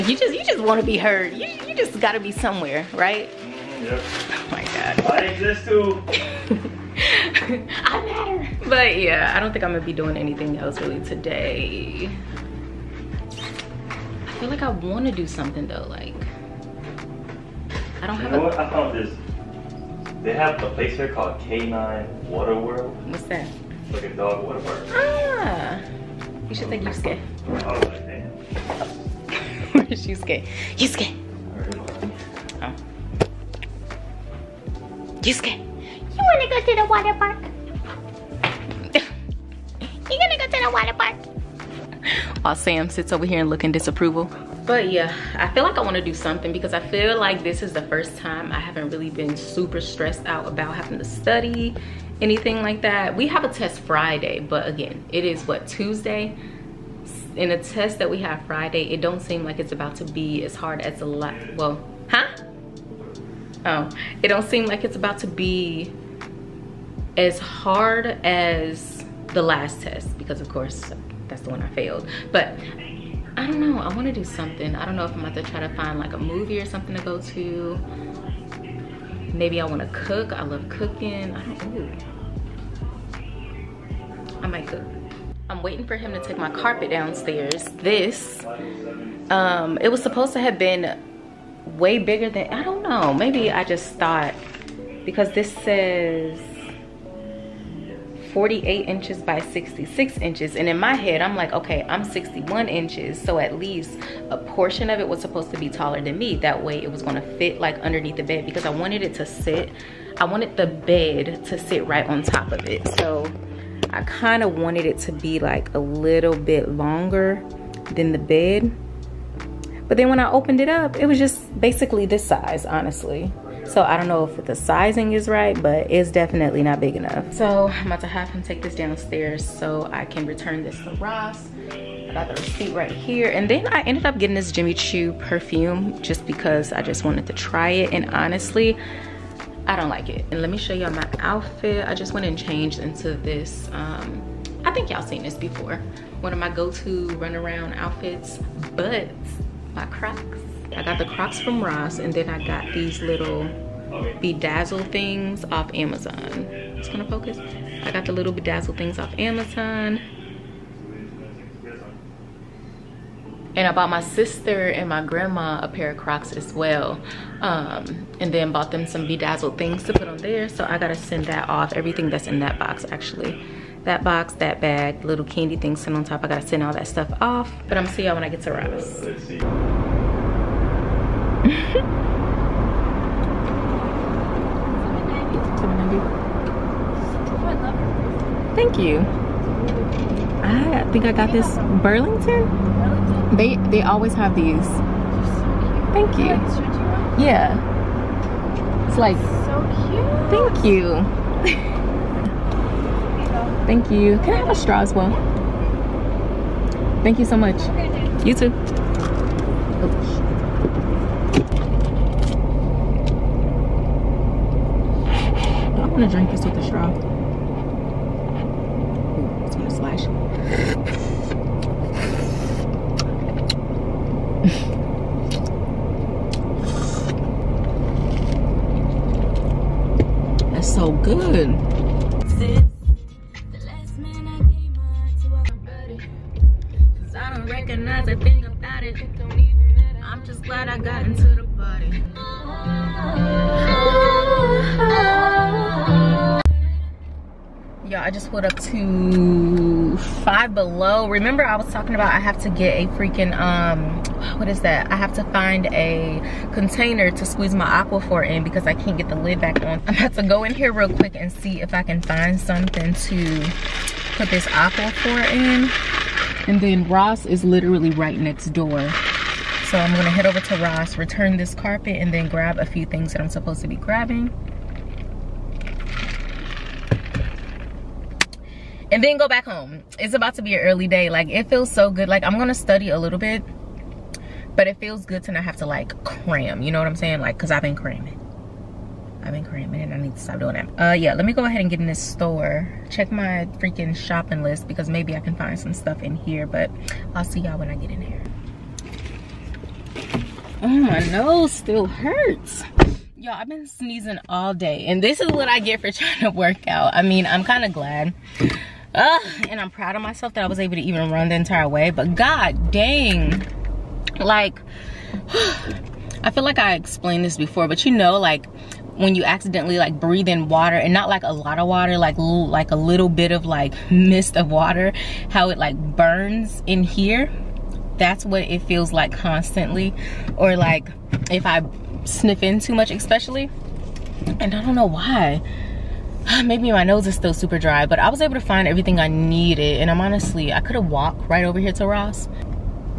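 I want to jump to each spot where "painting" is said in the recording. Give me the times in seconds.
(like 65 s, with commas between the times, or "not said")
not said.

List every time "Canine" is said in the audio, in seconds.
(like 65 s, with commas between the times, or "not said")
21 s.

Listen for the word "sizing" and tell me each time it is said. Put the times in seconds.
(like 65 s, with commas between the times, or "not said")
124 s.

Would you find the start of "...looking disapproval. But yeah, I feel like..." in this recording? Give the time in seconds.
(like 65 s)
43 s.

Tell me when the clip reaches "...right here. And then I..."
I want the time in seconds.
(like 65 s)
132 s.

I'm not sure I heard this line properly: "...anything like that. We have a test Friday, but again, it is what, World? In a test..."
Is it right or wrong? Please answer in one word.
wrong.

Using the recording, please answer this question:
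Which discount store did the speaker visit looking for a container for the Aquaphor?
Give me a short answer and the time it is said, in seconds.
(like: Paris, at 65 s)
Five Below, at 250 s.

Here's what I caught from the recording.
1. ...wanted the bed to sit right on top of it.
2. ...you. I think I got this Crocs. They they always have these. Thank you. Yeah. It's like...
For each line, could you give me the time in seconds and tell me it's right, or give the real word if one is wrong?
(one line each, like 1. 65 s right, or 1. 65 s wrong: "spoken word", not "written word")
1. 110 s right
2. 188 s wrong: "Burlington", not "Crocs".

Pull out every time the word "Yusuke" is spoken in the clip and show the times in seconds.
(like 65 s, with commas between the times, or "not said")
30 s.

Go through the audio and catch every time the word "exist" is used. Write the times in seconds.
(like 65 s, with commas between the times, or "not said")
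5 s.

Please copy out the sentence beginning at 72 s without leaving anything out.
But I don't know, I wanna do something.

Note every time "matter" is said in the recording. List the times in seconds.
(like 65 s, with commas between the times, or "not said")
8 s.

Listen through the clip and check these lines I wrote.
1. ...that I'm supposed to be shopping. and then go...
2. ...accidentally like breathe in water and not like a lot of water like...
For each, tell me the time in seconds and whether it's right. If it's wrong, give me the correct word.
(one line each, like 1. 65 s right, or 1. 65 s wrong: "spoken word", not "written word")
1. 273 s wrong: "grabbing", not "shopping"
2. 319 s right.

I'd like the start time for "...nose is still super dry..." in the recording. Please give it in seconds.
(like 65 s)
336 s.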